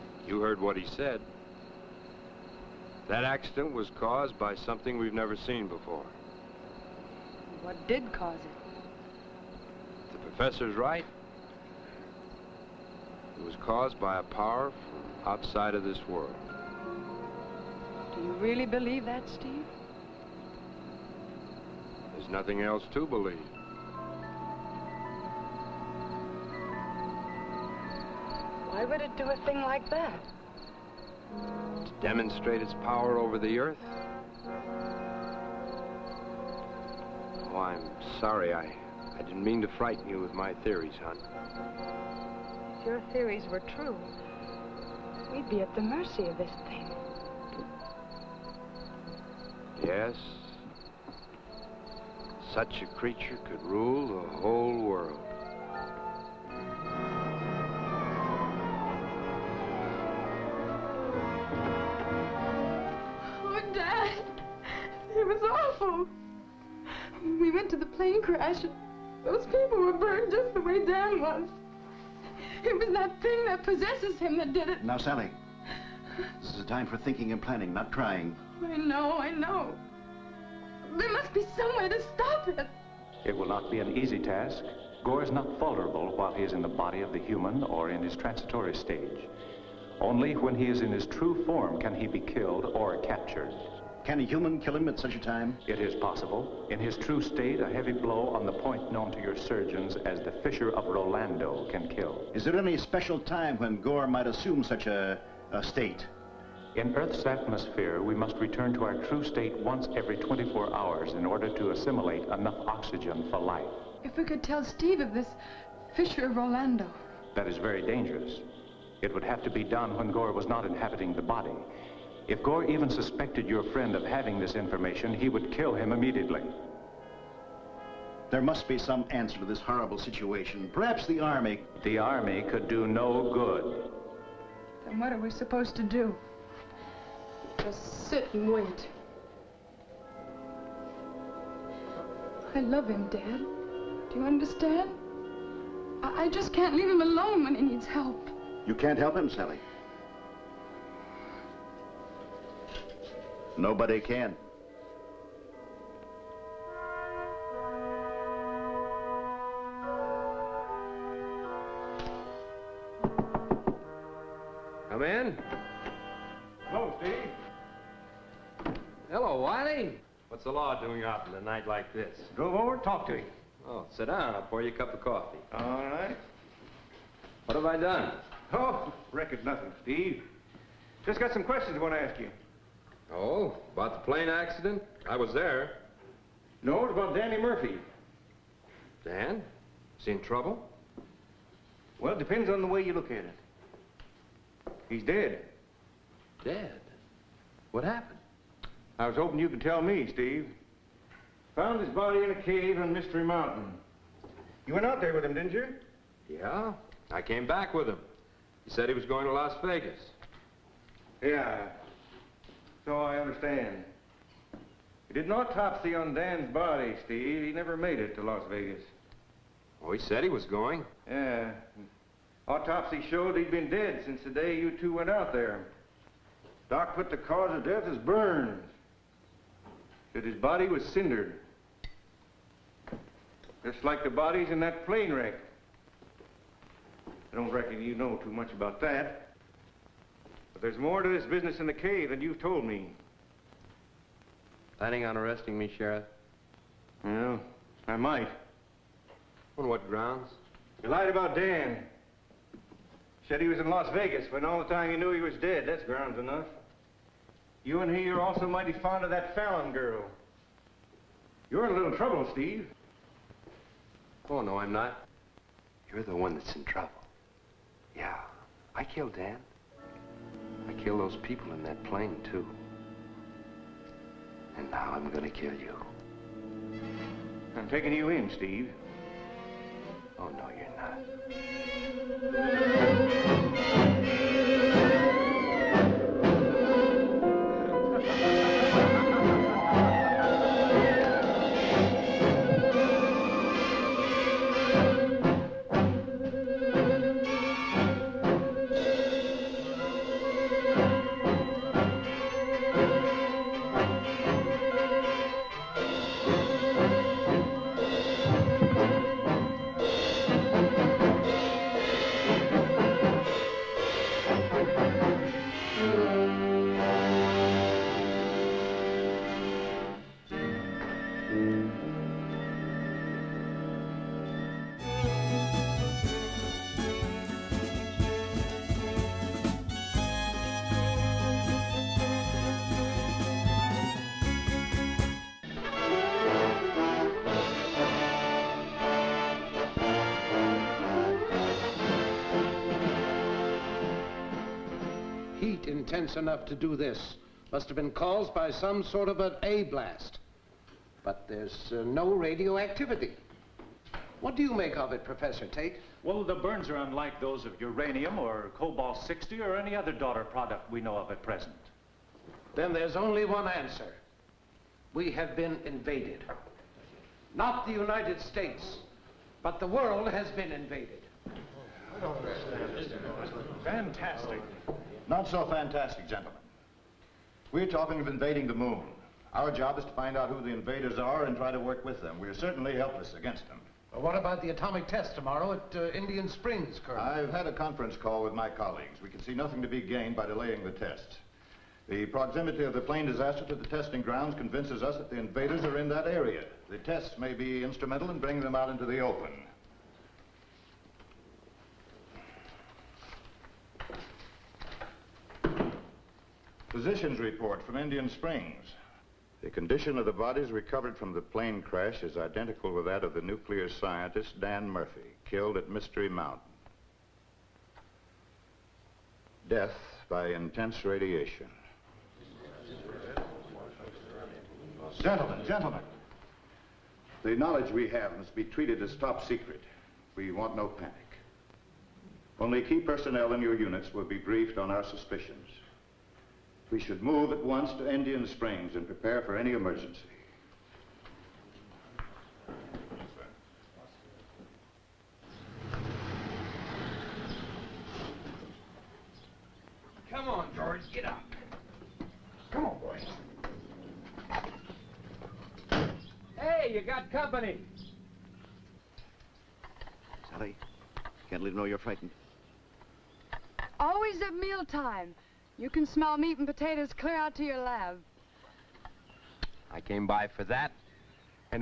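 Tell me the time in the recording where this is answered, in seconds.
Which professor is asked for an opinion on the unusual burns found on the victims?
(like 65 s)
355 s.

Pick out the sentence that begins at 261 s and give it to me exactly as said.
You're in a little trouble, Steve.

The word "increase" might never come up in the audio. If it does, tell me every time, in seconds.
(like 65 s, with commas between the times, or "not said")
not said.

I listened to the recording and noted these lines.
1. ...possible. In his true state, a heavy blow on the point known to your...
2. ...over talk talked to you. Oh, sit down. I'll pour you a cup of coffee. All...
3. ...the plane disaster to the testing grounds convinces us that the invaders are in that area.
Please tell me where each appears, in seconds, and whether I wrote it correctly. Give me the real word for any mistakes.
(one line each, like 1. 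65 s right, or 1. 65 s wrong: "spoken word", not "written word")
1. 95 s right
2. 172 s right
3. 392 s right.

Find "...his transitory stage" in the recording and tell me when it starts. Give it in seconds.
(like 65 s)
88 s.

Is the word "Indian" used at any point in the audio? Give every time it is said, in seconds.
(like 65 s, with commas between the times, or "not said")
385 s, 407 s, 437 s.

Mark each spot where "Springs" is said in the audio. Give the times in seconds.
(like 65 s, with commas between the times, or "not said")
386 s, 408 s, 438 s.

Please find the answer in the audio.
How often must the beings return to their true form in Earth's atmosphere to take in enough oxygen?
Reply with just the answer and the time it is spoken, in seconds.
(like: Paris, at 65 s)
Every 24 hours, at 109 s.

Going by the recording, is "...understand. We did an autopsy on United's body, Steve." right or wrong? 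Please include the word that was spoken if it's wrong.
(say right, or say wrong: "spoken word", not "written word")
wrong: "Dan", not "United".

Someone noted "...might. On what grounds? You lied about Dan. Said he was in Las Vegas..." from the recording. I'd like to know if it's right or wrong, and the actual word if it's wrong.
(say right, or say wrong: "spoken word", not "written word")
right.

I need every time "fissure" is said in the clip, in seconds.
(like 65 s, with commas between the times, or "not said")
100 s, 115 s.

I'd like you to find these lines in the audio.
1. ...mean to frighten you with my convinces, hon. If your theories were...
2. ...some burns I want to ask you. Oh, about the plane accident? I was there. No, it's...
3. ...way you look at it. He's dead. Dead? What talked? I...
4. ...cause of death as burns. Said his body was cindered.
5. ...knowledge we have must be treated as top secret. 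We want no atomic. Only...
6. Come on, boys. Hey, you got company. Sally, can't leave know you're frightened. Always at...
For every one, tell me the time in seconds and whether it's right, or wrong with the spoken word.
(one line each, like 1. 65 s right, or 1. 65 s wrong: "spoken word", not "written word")
1. 39 s wrong: "theories", not "convinces"
2. 181 s wrong: "questions", not "burns"
3. 192 s wrong: "happened", not "talked"
4. 227 s right
5. 427 s wrong: "panic", not "atomic"
6. 452 s right.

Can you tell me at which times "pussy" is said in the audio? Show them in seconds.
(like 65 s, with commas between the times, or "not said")
not said.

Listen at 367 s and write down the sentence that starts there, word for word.
Not the United States, but the world has been invaded.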